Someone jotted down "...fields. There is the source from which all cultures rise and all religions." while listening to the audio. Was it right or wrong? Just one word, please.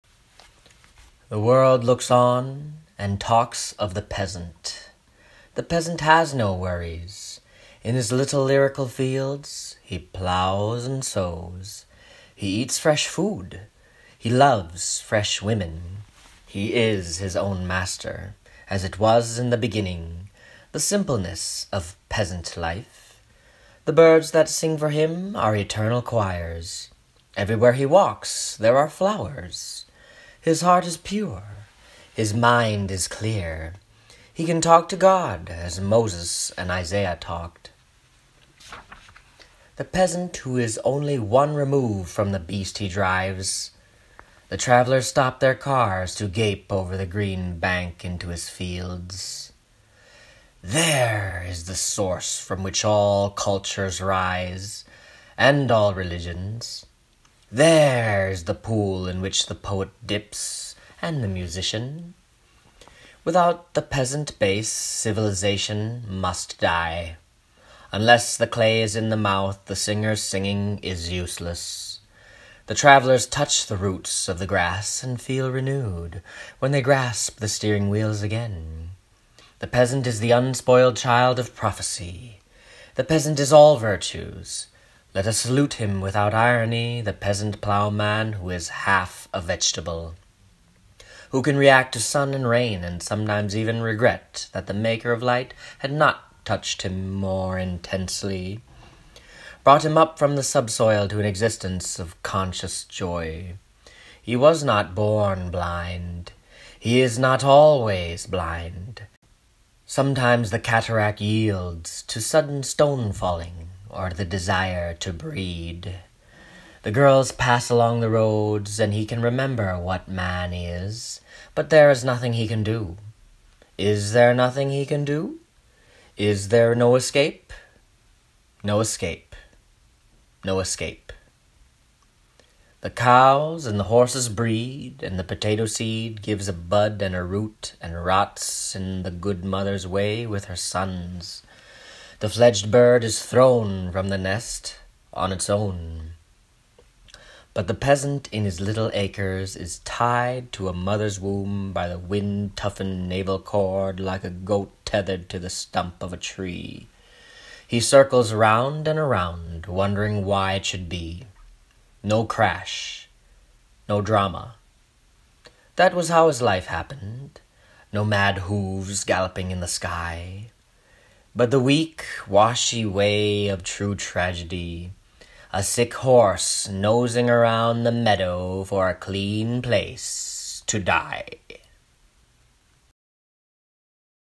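right.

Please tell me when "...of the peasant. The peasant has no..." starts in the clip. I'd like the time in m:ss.
0:03.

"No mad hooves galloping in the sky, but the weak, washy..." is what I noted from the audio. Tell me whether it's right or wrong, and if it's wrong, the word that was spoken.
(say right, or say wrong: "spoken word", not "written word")
right.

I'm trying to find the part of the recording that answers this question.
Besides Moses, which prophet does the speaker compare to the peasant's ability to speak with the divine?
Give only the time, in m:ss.
0:36.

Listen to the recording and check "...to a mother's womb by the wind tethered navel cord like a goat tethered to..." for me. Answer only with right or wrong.
wrong.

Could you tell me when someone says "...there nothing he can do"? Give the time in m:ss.
2:04.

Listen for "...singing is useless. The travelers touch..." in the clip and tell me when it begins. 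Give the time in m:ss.
1:10.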